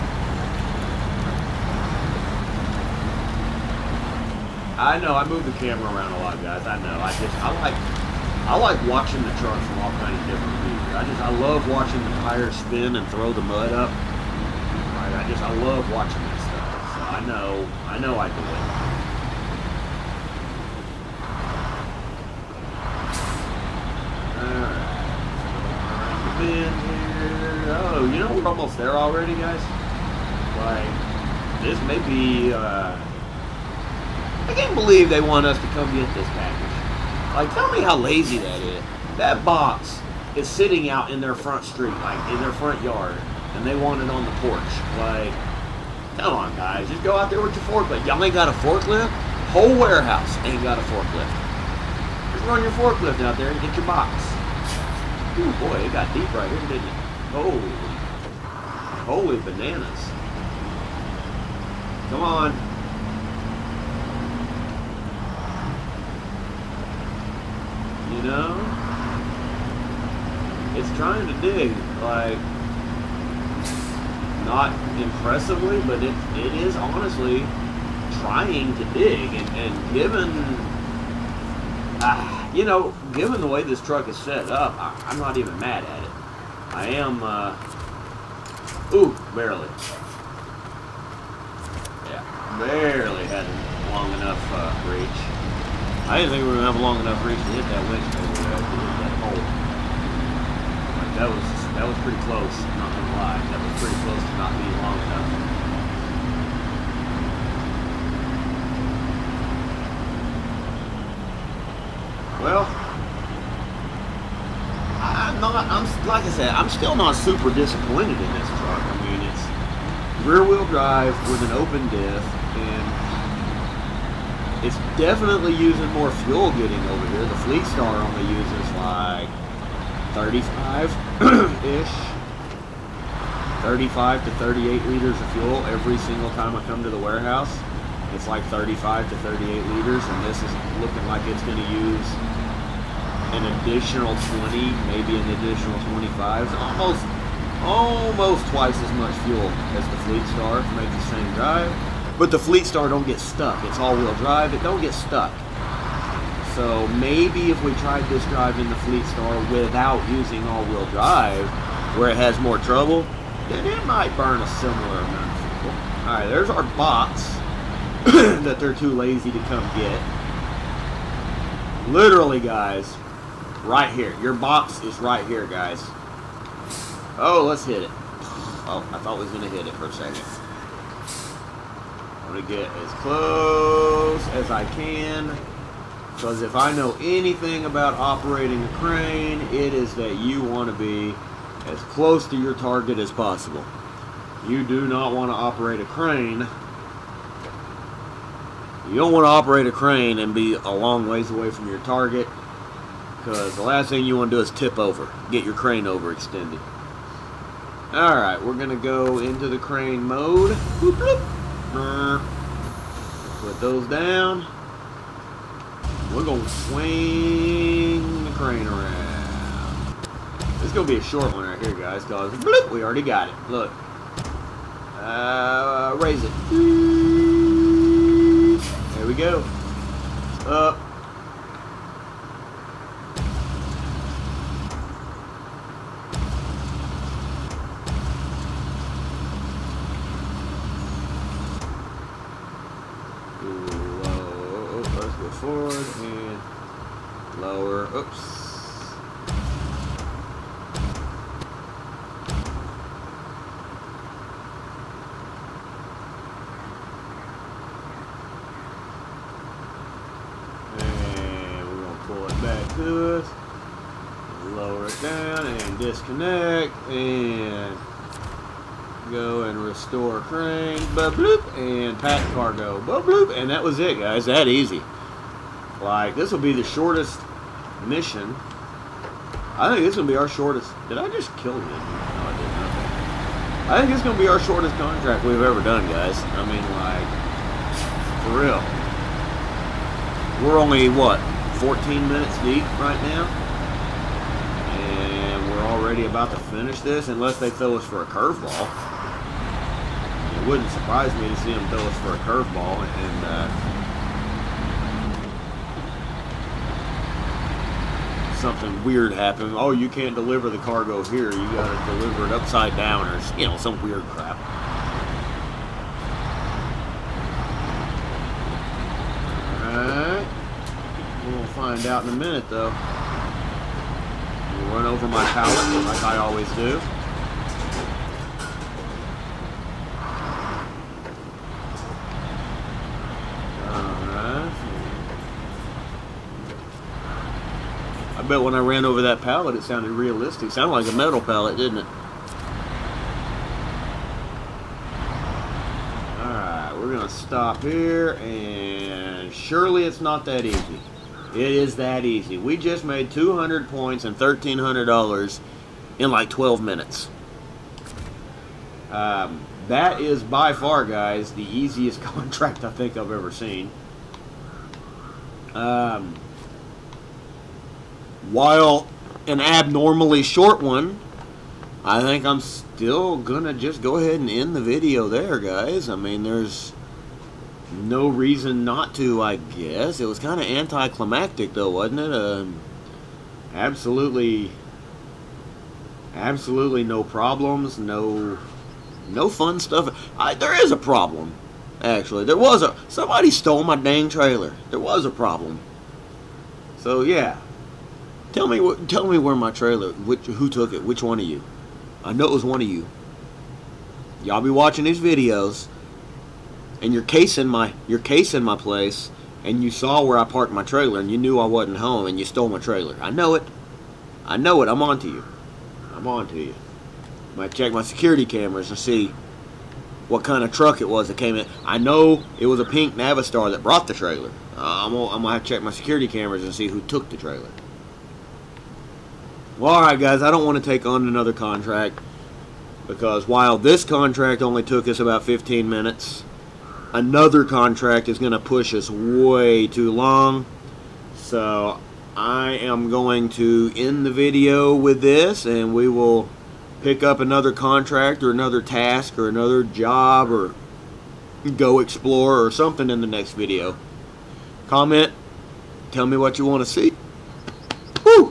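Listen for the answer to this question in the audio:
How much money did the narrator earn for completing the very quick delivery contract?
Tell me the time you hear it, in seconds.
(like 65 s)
354 s.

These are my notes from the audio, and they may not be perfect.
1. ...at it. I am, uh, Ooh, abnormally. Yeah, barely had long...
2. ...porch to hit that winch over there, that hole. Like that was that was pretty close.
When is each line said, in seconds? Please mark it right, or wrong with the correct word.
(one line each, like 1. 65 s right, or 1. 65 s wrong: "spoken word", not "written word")
1. 85 s wrong: "barely", not "abnormally"
2. 97 s wrong: "reach", not "porch".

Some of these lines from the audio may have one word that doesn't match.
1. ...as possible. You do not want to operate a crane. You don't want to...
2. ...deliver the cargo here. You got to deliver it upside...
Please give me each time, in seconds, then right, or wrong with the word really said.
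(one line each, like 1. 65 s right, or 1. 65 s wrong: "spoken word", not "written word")
1. 192 s right
2. 310 s right.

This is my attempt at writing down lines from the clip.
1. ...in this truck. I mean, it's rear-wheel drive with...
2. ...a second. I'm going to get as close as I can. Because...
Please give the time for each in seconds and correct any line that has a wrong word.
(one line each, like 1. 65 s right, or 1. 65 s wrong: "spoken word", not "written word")
1. 118 s right
2. 179 s right.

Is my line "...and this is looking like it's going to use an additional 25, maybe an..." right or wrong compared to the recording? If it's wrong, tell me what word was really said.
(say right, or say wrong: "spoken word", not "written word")
wrong: "20", not "25".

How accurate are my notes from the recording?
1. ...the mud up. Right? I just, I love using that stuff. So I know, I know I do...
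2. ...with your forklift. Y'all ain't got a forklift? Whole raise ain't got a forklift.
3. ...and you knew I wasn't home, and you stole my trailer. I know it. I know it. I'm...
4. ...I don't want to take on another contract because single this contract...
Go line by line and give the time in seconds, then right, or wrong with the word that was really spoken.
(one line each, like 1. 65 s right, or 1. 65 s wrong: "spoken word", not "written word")
1. 13 s wrong: "watching", not "using"
2. 47 s wrong: "warehouse", not "raise"
3. 411 s right
4. 430 s wrong: "while", not "single".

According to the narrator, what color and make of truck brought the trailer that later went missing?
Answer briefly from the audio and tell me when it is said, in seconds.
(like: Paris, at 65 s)
pink Navistar, at 422 s.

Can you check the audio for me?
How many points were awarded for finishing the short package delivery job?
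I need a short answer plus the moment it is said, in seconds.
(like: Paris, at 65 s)
200, at 353 s.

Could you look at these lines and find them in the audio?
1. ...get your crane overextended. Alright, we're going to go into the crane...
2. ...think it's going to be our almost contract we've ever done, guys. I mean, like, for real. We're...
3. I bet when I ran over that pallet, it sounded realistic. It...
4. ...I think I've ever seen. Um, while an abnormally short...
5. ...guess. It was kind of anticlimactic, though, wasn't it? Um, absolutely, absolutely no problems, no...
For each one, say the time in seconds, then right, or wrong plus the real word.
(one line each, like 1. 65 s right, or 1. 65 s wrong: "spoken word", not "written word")
1. 205 s right
2. 283 s wrong: "shortest", not "almost"
3. 338 s right
4. 362 s right
5. 379 s right.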